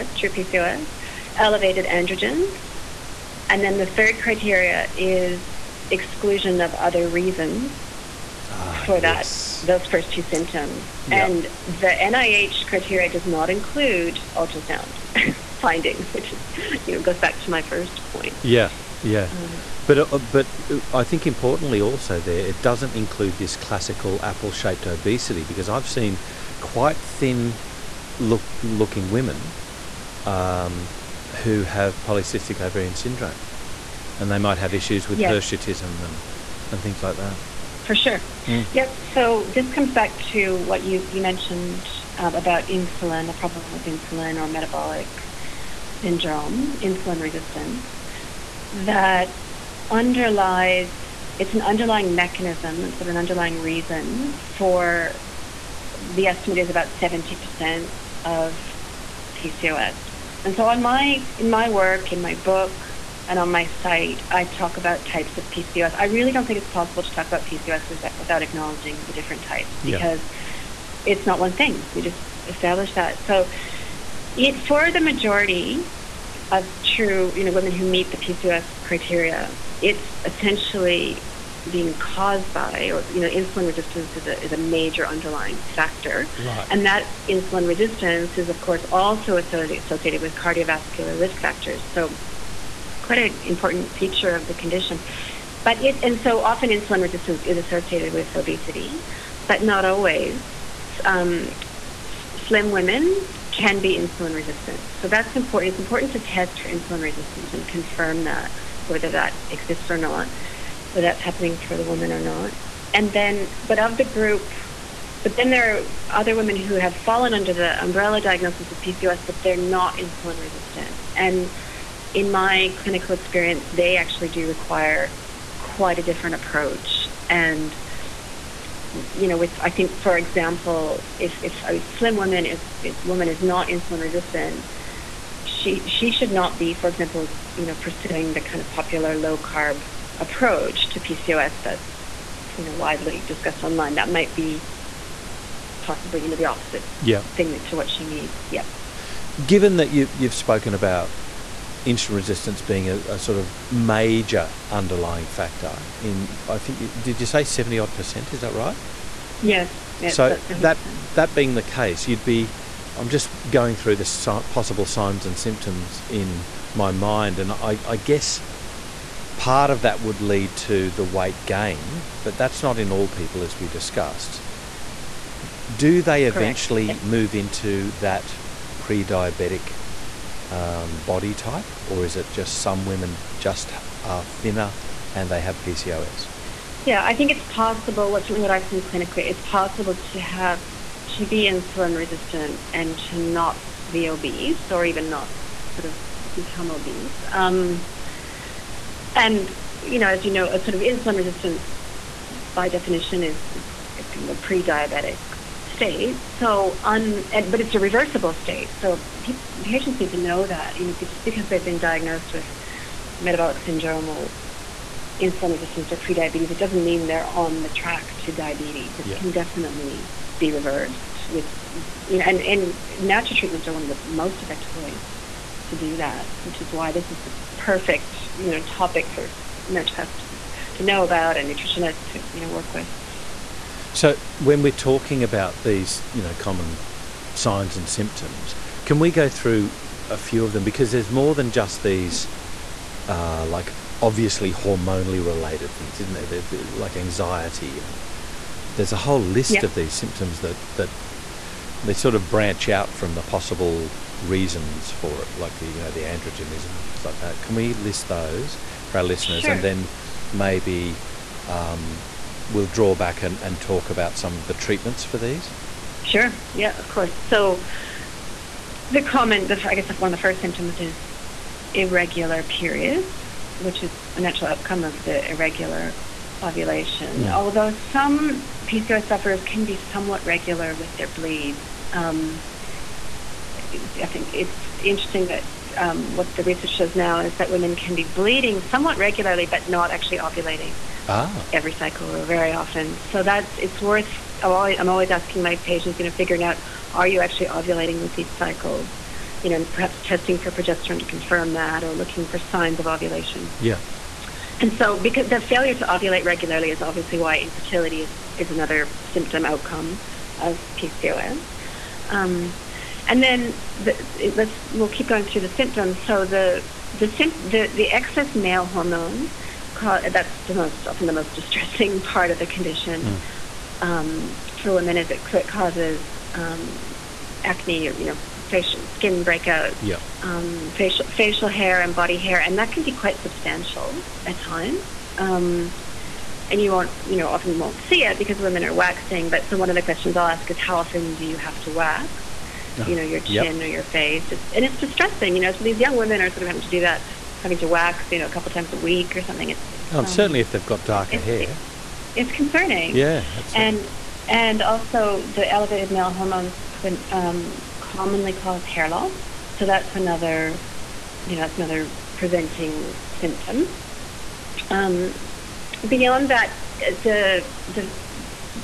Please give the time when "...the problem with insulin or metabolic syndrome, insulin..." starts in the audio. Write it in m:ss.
0:43.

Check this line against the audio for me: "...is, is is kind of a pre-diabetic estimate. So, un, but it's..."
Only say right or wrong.
wrong.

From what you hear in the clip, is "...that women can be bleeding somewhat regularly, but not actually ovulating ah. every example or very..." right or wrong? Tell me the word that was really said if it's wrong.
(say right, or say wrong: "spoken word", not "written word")
wrong: "cycle", not "example".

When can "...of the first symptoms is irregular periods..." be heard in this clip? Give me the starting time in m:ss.
4:30.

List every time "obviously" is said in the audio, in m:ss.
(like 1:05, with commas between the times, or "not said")
4:03, 5:06.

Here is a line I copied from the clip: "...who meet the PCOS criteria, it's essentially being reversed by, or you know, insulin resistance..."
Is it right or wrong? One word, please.
wrong.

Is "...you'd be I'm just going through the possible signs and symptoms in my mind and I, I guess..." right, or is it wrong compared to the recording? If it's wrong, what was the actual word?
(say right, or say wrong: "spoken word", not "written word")
right.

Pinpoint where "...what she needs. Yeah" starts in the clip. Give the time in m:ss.
2:27.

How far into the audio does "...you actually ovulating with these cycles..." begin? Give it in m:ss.
4:57.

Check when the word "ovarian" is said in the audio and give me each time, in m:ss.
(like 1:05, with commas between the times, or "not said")
0:32.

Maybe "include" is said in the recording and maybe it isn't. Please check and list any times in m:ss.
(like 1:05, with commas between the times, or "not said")
0:13, 0:22.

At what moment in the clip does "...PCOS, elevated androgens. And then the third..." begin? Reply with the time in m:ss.
0:00.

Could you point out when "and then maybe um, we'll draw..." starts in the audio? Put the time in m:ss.
4:19.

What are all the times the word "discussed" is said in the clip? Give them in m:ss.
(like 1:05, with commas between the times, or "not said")
2:23, 2:53.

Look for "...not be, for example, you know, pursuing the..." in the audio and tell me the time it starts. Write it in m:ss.
2:16.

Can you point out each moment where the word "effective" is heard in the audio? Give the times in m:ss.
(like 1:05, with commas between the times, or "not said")
3:44.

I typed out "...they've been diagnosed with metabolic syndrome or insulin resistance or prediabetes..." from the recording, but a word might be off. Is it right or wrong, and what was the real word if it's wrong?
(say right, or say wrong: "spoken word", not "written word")
right.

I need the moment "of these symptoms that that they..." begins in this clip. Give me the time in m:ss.
4:09.